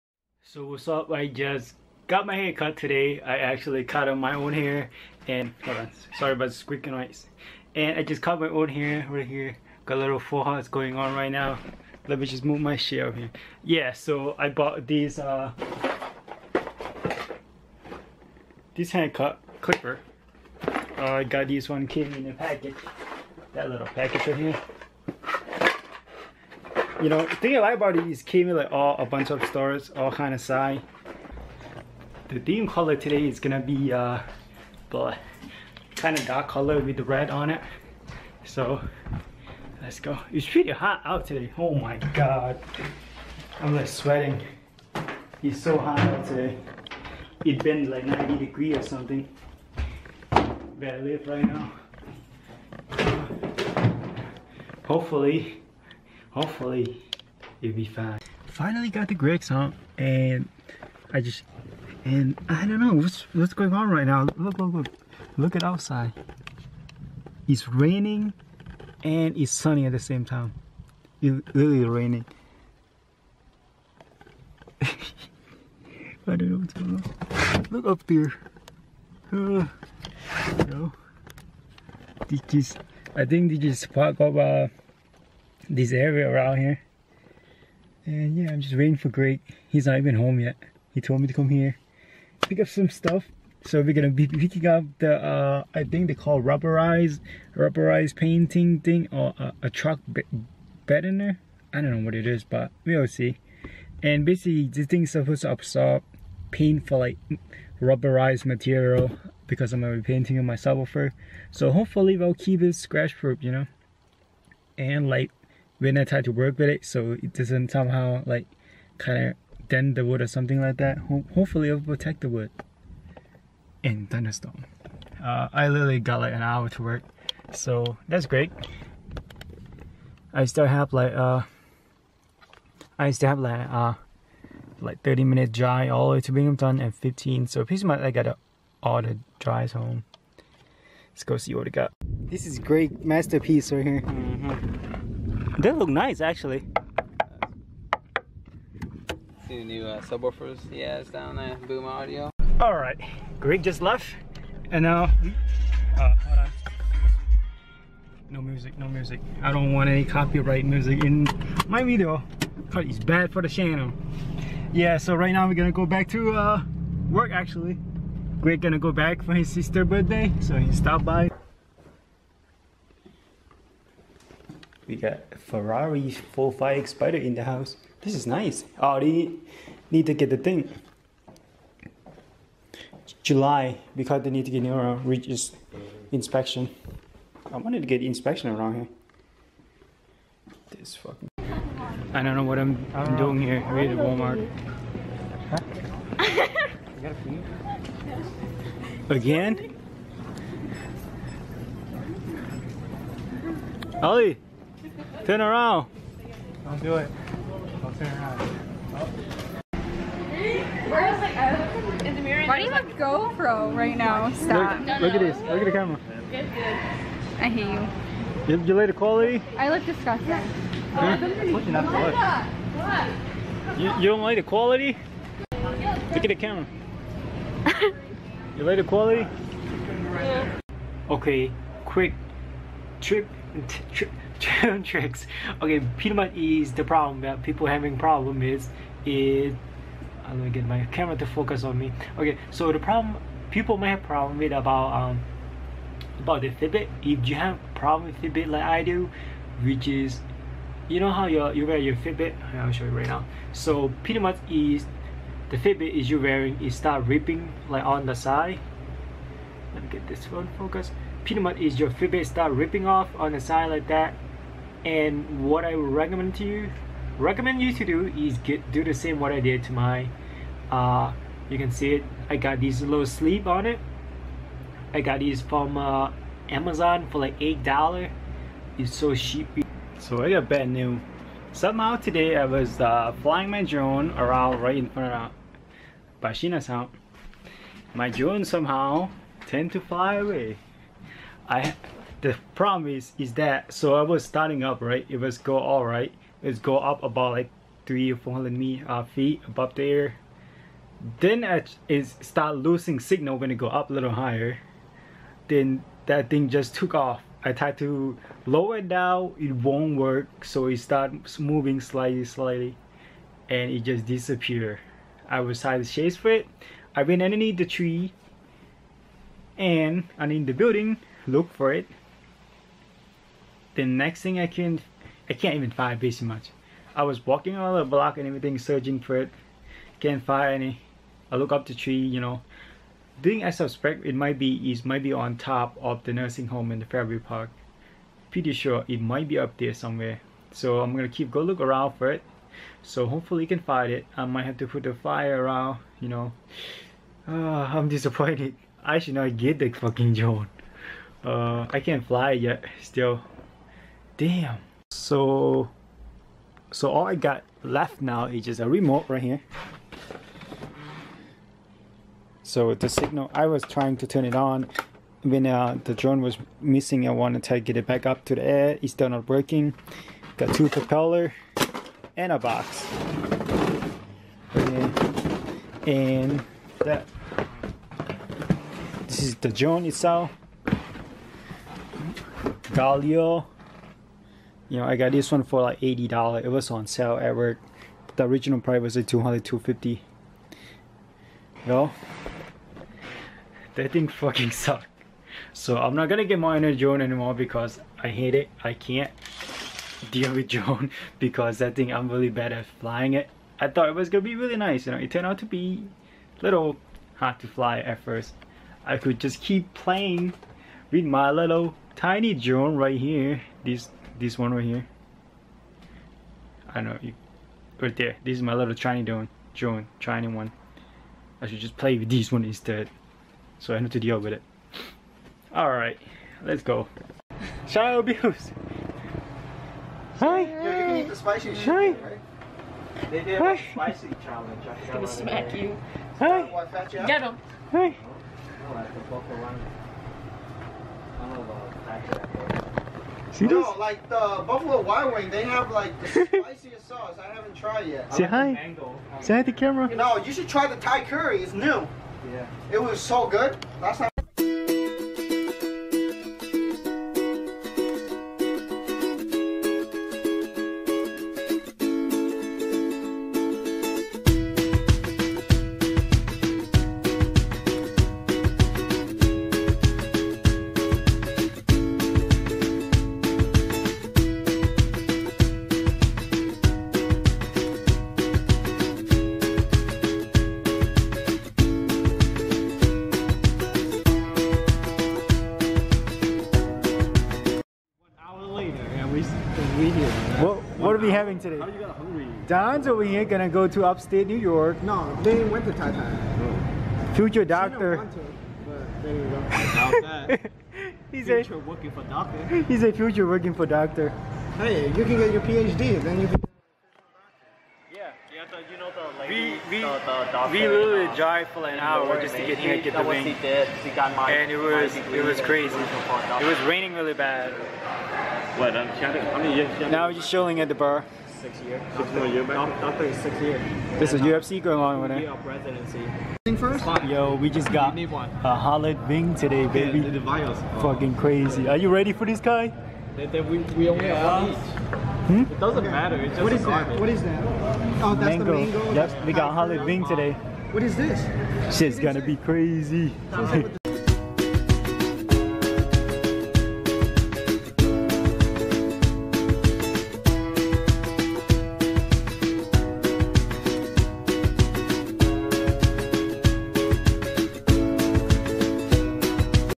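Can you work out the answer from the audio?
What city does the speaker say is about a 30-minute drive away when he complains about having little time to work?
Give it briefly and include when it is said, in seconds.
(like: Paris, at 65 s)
Binghamton, at 136 s.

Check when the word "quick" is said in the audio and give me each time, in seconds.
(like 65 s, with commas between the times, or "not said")
231 s.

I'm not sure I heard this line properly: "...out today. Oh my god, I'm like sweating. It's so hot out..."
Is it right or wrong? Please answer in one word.
right.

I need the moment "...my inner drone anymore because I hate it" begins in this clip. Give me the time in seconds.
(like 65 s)
396 s.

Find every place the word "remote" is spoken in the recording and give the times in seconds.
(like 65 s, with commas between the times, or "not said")
358 s.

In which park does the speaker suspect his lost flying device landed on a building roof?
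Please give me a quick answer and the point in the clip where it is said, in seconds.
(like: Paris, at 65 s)
Fairview Park, at 336 s.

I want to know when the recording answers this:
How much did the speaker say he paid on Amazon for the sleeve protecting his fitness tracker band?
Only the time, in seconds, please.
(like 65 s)
277 s.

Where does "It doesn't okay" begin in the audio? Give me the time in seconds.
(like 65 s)
535 s.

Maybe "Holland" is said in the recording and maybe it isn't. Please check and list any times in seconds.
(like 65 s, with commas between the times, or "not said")
528 s, 539 s.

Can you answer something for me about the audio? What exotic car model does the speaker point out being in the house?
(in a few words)
Ferrari 458 Spider.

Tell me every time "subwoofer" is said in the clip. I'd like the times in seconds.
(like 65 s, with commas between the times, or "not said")
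110 s, 150 s.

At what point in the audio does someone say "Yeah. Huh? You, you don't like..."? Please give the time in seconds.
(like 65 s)
220 s.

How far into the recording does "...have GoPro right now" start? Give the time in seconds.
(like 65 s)
212 s.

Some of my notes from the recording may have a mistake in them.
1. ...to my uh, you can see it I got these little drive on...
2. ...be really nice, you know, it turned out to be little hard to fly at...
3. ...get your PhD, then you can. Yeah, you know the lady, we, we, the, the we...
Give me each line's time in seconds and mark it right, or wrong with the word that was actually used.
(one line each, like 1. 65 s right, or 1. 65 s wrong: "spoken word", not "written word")
1. 269 s wrong: "sleeve", not "drive"
2. 404 s right
3. 505 s right.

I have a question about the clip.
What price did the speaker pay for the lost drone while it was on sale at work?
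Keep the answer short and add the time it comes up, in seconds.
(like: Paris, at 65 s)
$80, at 385 s.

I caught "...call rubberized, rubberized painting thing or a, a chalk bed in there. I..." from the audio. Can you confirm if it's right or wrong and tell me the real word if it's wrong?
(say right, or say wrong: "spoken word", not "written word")
right.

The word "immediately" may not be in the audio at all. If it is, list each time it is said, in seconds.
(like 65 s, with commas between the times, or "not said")
not said.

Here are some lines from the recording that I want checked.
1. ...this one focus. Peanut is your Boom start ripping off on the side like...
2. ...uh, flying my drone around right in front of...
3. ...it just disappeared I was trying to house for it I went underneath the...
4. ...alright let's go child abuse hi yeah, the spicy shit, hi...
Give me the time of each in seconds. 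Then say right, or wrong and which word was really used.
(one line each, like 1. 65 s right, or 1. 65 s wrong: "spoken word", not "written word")
1. 260 s wrong: "Fitbit", not "Boom"
2. 282 s right
3. 313 s wrong: "chase", not "house"
4. 425 s right.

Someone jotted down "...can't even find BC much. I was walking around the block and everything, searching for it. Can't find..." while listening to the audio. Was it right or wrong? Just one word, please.
right.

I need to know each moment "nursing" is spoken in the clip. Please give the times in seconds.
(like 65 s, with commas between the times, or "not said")
336 s.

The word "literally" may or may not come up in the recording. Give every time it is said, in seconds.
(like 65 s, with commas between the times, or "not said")
71 s, 125 s, 510 s.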